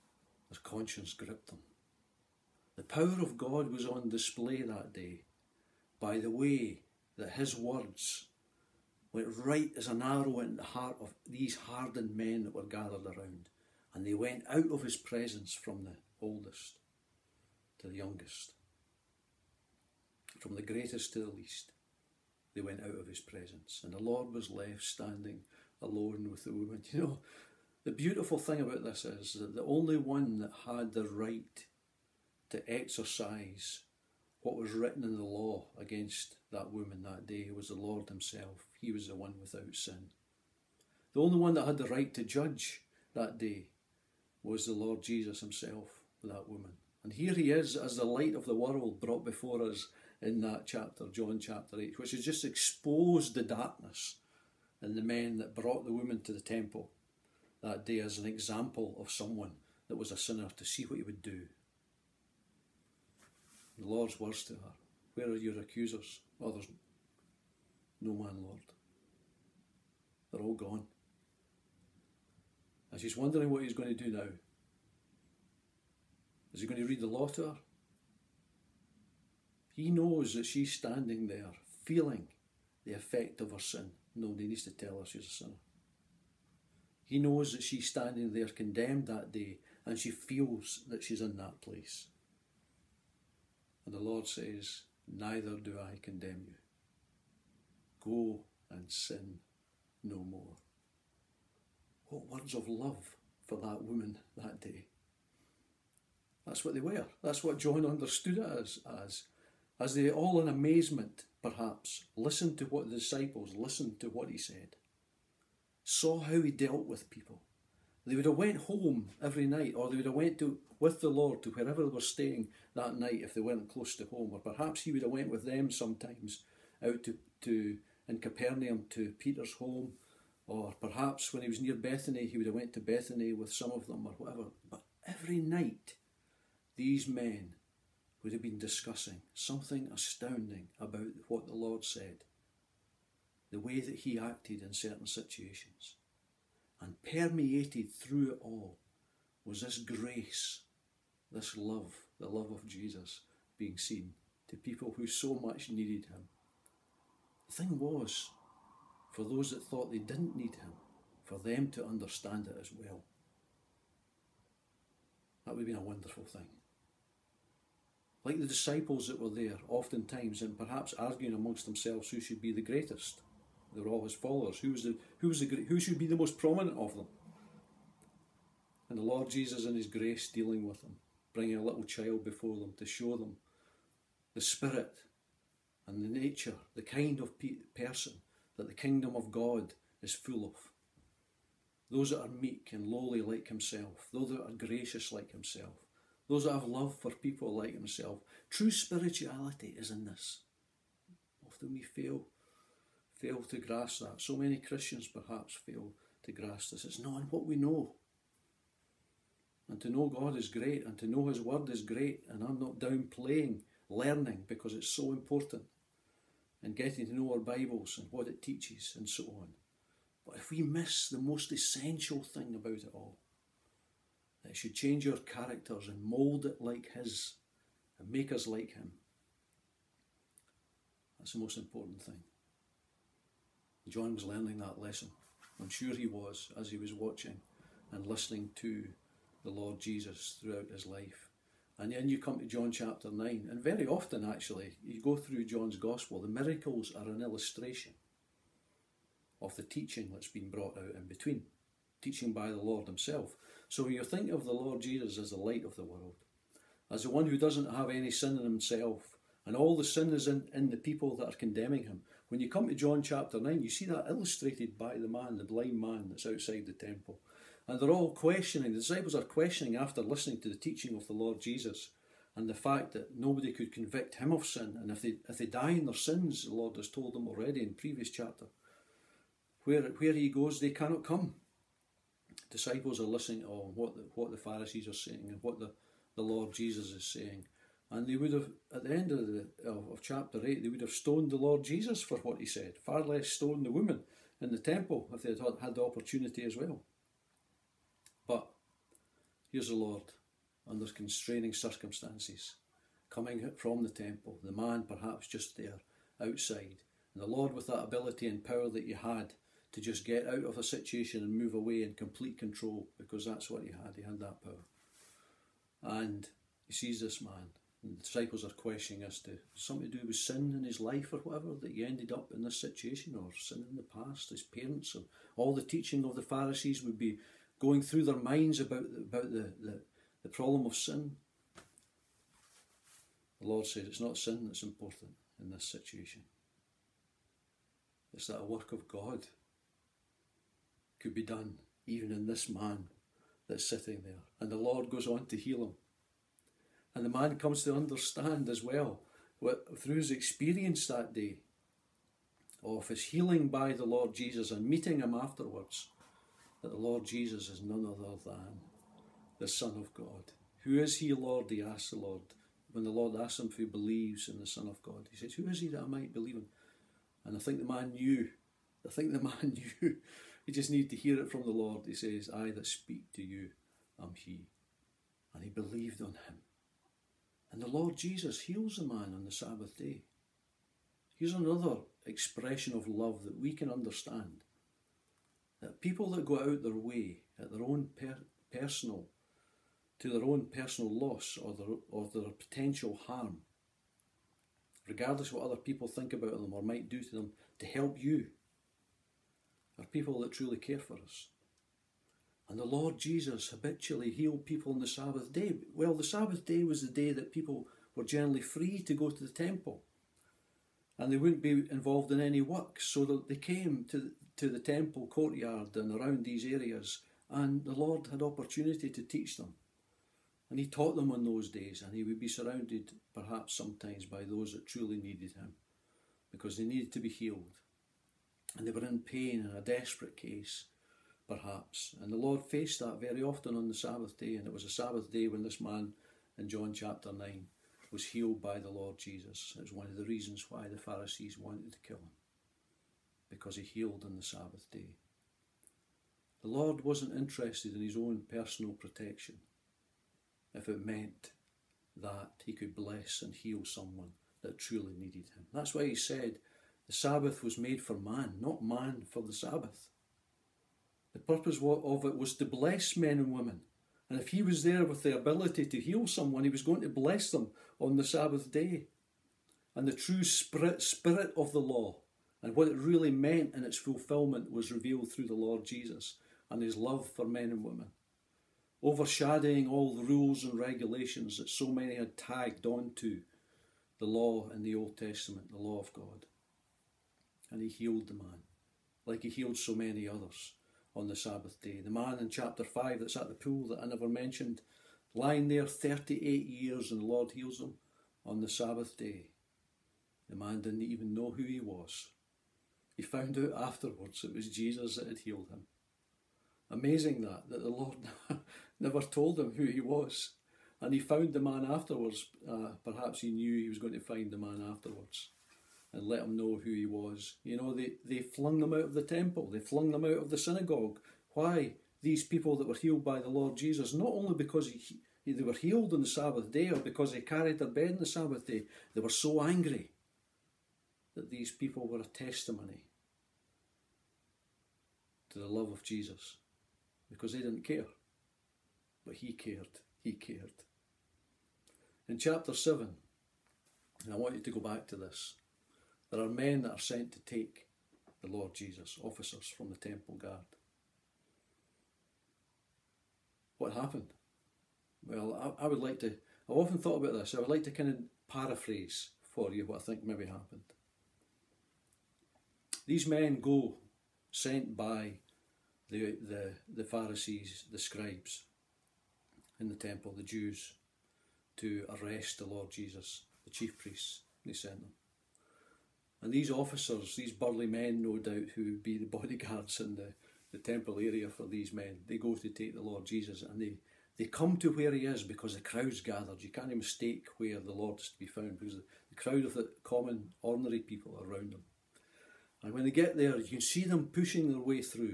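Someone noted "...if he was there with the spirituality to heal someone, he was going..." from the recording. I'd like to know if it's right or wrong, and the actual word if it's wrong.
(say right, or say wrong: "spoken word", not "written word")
wrong: "ability", not "spirituality".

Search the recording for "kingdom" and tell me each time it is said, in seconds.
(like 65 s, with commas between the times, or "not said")
188 s.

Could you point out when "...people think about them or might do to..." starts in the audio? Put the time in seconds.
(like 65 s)
395 s.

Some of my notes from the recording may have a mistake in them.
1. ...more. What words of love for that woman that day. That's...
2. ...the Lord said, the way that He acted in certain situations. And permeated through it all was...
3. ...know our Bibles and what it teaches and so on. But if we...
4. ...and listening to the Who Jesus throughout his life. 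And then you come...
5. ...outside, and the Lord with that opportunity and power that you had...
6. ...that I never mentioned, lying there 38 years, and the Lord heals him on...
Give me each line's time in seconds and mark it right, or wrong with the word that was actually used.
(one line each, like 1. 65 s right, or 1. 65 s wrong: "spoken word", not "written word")
1. 100 s right
2. 141 s right
3. 217 s right
4. 237 s wrong: "Lord", not "Who"
5. 306 s wrong: "ability", not "opportunity"
6. 493 s right.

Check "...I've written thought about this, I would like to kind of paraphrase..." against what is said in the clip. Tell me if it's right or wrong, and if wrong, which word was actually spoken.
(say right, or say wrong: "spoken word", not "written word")
wrong: "often", not "written".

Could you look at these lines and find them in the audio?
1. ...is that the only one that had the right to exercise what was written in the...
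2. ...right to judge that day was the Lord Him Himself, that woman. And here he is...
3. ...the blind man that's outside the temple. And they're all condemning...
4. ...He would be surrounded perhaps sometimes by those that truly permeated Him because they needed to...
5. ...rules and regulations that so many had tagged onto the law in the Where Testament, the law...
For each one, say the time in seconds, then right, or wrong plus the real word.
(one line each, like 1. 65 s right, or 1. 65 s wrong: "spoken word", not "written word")
1. 29 s right
2. 41 s wrong: "Jesus", not "Him"
3. 265 s wrong: "questioning", not "condemning"
4. 421 s wrong: "needed", not "permeated"
5. 480 s wrong: "Old", not "Where".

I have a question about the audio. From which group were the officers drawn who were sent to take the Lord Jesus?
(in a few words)
The temple guard.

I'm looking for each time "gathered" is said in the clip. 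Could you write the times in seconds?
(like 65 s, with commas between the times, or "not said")
12 s, 586 s.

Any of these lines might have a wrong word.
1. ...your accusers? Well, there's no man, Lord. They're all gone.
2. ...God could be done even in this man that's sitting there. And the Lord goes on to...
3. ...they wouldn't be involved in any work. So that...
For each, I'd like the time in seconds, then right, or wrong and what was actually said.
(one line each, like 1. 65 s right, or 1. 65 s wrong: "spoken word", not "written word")
1. 65 s right
2. 338 s right
3. 411 s right.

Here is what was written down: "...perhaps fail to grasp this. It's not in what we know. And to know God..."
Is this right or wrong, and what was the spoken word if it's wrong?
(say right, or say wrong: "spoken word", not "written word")
right.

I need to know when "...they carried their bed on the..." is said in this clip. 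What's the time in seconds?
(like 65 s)
527 s.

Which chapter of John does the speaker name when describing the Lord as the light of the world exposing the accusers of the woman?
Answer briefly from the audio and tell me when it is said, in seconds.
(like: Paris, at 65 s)
John chapter 8, at 51 s.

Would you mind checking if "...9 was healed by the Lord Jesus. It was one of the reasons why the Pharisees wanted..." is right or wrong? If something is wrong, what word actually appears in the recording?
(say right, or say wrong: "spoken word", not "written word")
right.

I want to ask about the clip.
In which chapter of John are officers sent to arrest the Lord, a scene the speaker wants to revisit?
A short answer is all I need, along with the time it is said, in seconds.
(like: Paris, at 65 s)
Chapter 7, at 542 s.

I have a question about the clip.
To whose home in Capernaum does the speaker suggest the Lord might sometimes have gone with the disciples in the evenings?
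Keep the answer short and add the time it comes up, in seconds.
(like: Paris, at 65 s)
Peter's home, at 129 s.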